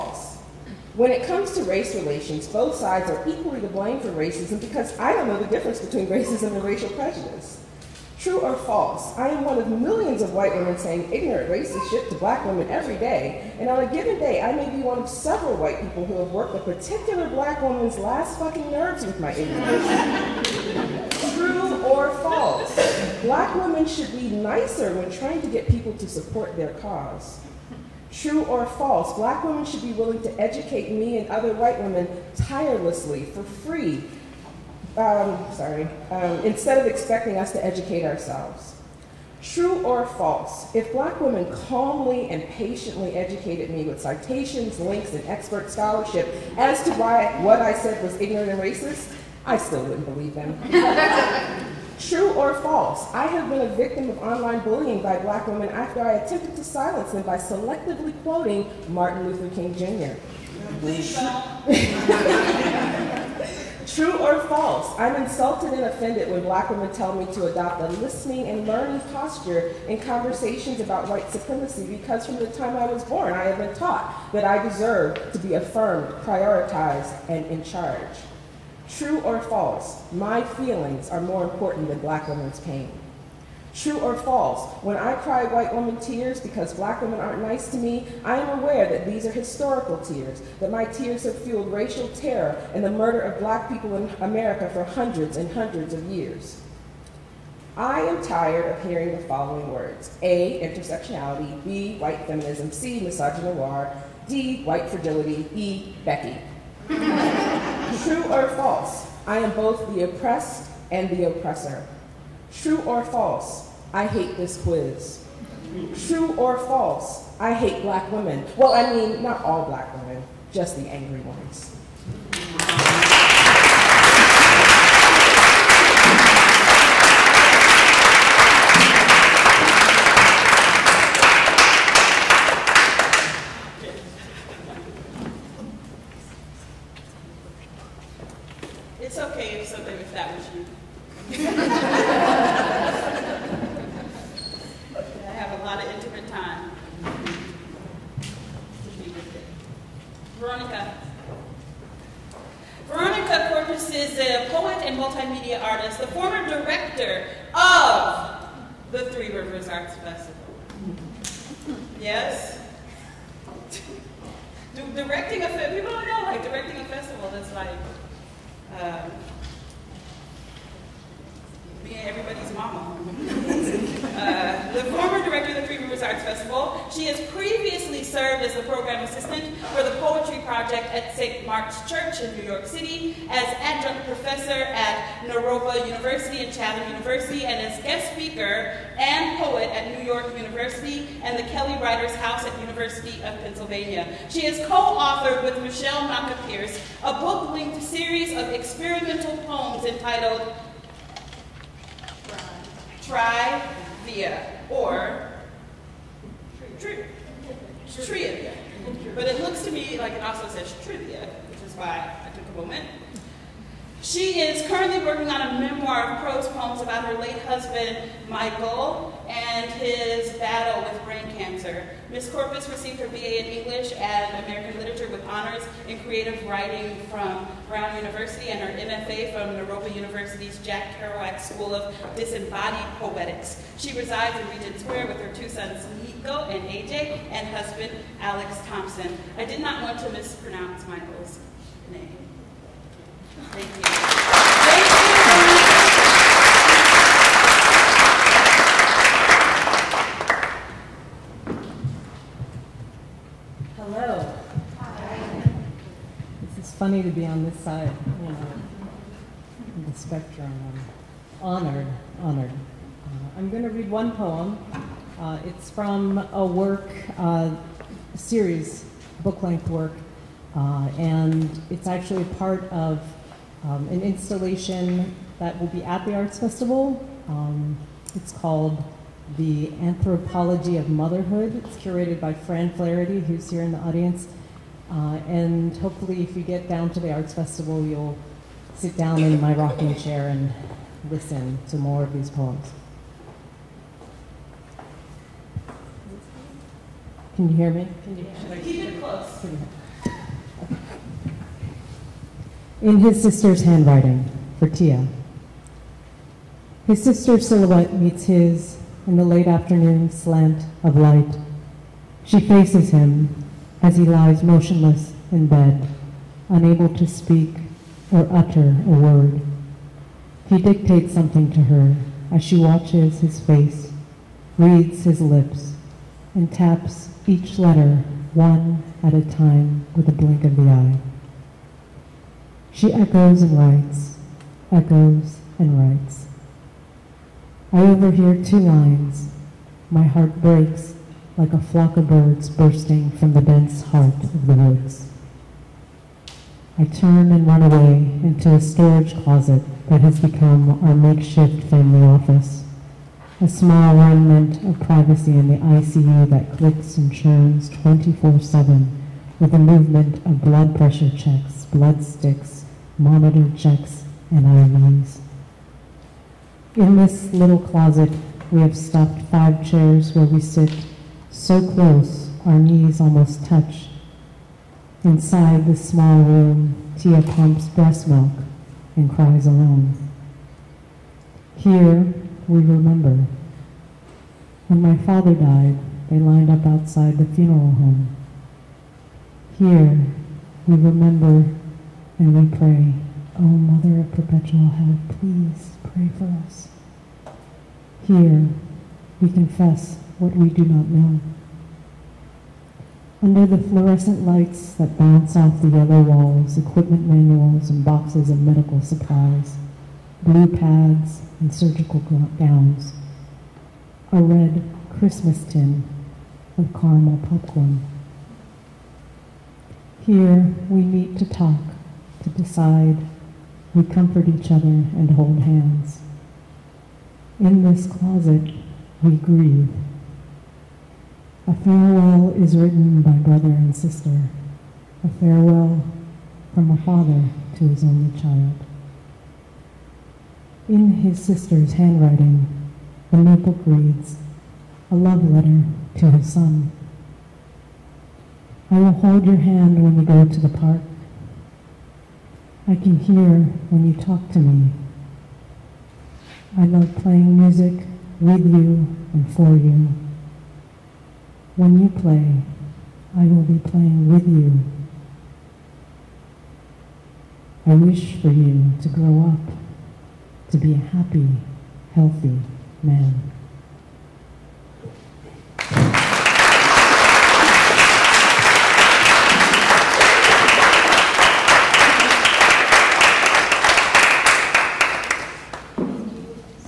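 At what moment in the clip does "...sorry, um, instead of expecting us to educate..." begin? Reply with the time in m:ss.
0:35.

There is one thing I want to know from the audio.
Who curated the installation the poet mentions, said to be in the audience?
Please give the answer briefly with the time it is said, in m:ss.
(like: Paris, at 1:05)
Fran Flaherty, at 4:42.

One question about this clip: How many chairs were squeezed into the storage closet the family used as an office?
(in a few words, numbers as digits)
5.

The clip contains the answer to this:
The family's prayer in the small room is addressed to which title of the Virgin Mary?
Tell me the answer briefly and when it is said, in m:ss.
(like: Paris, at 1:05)
Mother of Perpetual Help, at 6:33.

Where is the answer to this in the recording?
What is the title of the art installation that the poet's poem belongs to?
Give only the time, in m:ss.
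4:39.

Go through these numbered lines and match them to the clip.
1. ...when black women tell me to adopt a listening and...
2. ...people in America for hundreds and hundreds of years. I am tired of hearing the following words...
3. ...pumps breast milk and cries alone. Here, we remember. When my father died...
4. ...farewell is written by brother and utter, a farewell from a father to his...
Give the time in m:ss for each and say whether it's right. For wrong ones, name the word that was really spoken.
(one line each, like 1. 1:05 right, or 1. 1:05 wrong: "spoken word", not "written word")
1. 1:06 right
2. 1:33 right
3. 6:17 right
4. 7:11 wrong: "sister", not "utter".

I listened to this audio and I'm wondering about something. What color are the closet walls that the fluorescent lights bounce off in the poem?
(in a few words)
yellow.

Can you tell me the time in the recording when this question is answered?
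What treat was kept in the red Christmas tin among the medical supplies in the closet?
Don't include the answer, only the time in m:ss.
6:56.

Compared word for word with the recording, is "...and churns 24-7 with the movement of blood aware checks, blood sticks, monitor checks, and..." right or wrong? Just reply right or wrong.
wrong.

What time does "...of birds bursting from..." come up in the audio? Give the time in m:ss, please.
5:41.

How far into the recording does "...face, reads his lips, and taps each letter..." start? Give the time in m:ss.
5:23.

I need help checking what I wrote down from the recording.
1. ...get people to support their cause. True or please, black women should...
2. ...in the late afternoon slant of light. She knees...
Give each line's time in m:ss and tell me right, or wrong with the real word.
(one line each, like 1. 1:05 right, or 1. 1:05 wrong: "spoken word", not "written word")
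1. 0:25 wrong: "false", not "please"
2. 5:09 wrong: "faces", not "knees".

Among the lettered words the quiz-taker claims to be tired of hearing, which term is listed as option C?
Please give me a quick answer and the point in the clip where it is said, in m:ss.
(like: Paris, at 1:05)
misogynoir, at 1:42.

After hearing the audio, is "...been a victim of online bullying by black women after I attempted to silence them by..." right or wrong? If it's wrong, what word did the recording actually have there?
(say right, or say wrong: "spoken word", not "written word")
right.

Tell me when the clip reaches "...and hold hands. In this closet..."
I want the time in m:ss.
7:04.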